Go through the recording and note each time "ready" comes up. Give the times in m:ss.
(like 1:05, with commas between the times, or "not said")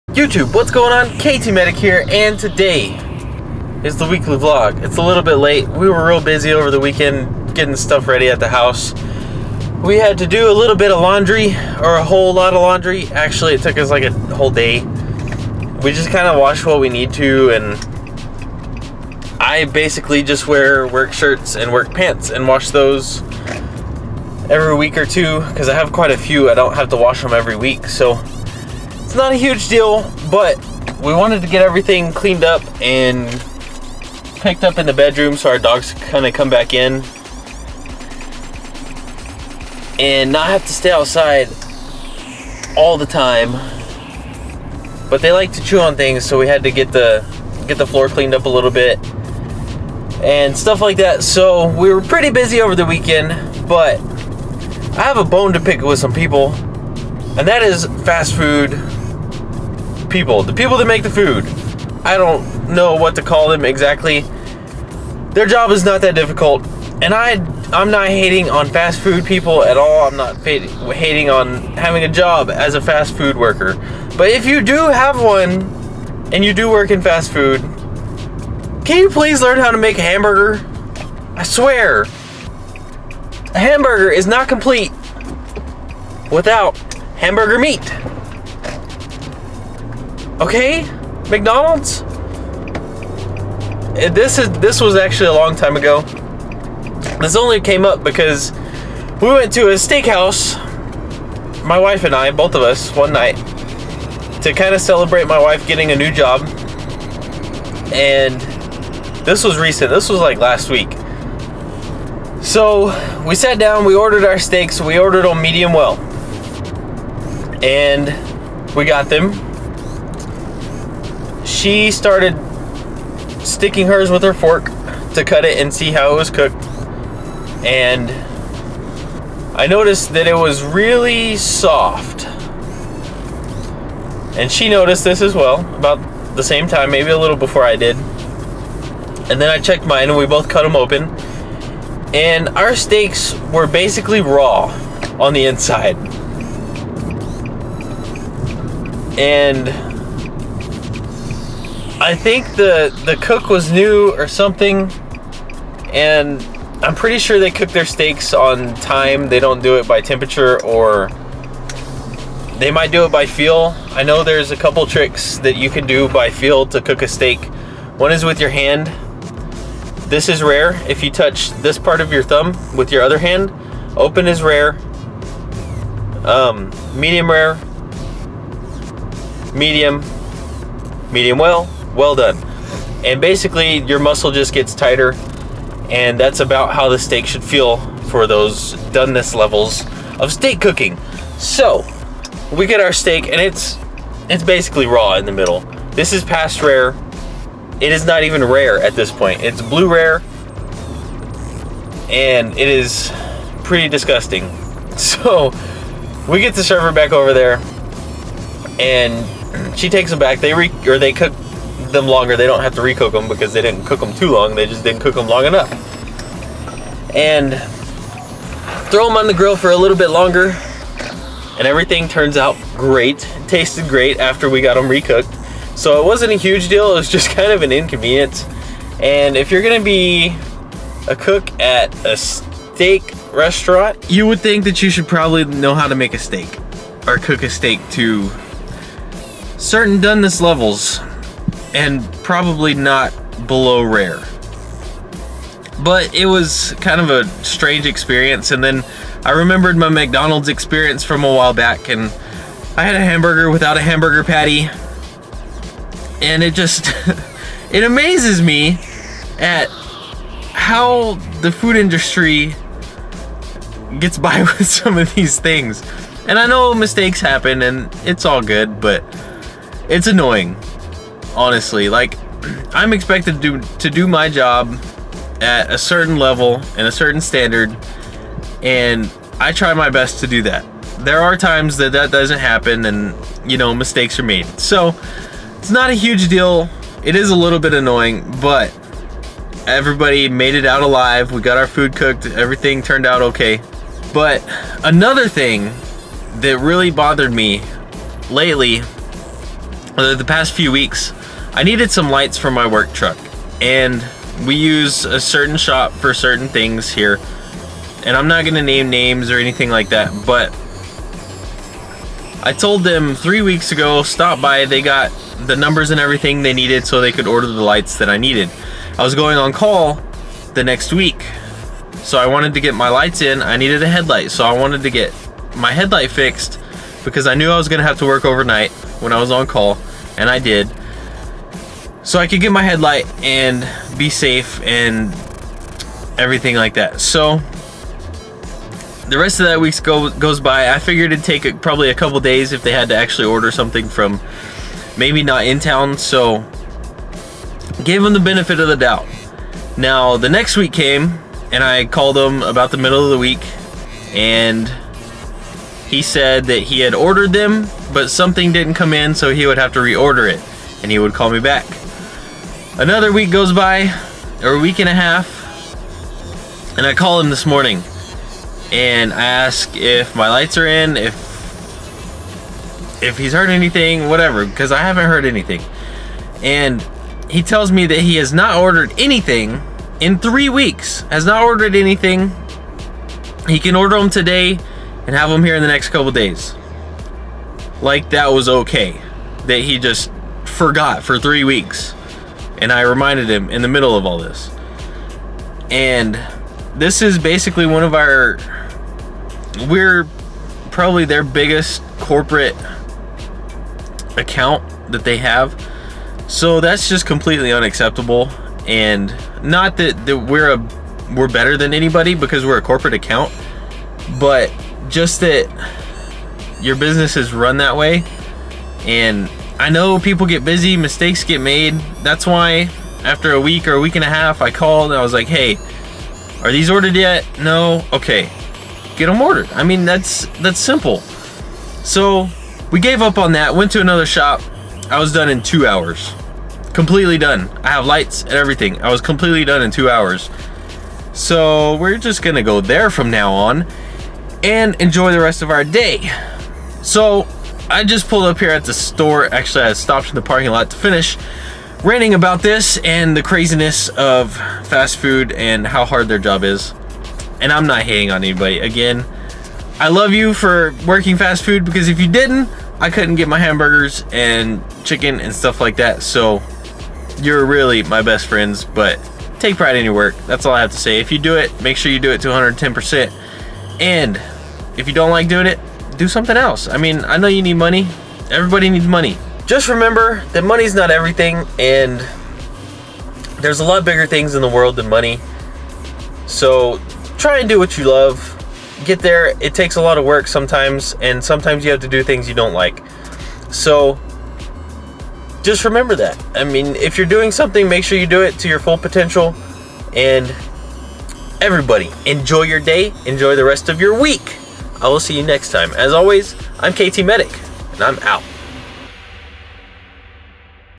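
0:08.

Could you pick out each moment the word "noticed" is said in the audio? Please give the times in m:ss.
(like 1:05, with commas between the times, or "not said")
2:09, 2:14.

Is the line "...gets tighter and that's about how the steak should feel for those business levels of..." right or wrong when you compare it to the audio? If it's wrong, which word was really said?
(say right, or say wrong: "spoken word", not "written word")
wrong: "doneness", not "business".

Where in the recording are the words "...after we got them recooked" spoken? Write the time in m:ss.
3:44.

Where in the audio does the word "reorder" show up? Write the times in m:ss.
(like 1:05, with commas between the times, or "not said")
5:59.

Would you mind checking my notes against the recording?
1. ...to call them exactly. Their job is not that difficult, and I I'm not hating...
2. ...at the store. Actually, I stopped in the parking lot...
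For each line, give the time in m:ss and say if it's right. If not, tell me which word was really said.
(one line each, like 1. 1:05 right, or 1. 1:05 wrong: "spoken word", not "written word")
1. 1:03 right
2. 7:28 right.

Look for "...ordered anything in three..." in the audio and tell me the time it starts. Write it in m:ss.
6:18.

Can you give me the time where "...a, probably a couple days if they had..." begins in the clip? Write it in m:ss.
5:41.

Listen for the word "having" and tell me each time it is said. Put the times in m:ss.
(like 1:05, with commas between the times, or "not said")
1:11.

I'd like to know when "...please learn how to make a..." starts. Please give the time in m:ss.
1:19.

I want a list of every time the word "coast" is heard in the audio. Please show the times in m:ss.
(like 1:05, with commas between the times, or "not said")
not said.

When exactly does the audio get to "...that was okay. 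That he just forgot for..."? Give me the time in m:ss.
6:28.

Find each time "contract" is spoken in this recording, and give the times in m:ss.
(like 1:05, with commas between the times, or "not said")
not said.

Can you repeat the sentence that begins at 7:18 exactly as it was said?
I was completely done in two hours.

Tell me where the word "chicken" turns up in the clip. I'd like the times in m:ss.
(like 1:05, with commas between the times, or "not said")
7:44.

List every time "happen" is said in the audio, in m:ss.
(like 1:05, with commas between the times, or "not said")
4:27, 4:42.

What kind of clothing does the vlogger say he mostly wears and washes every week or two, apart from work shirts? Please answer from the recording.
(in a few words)
work pants.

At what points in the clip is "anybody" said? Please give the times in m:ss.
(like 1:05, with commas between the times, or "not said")
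6:51, 7:38.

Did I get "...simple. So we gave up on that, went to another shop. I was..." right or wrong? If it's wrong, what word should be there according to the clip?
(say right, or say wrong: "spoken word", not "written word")
right.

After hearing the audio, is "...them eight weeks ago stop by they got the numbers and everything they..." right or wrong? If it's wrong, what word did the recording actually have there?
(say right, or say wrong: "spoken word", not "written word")
wrong: "three", not "eight".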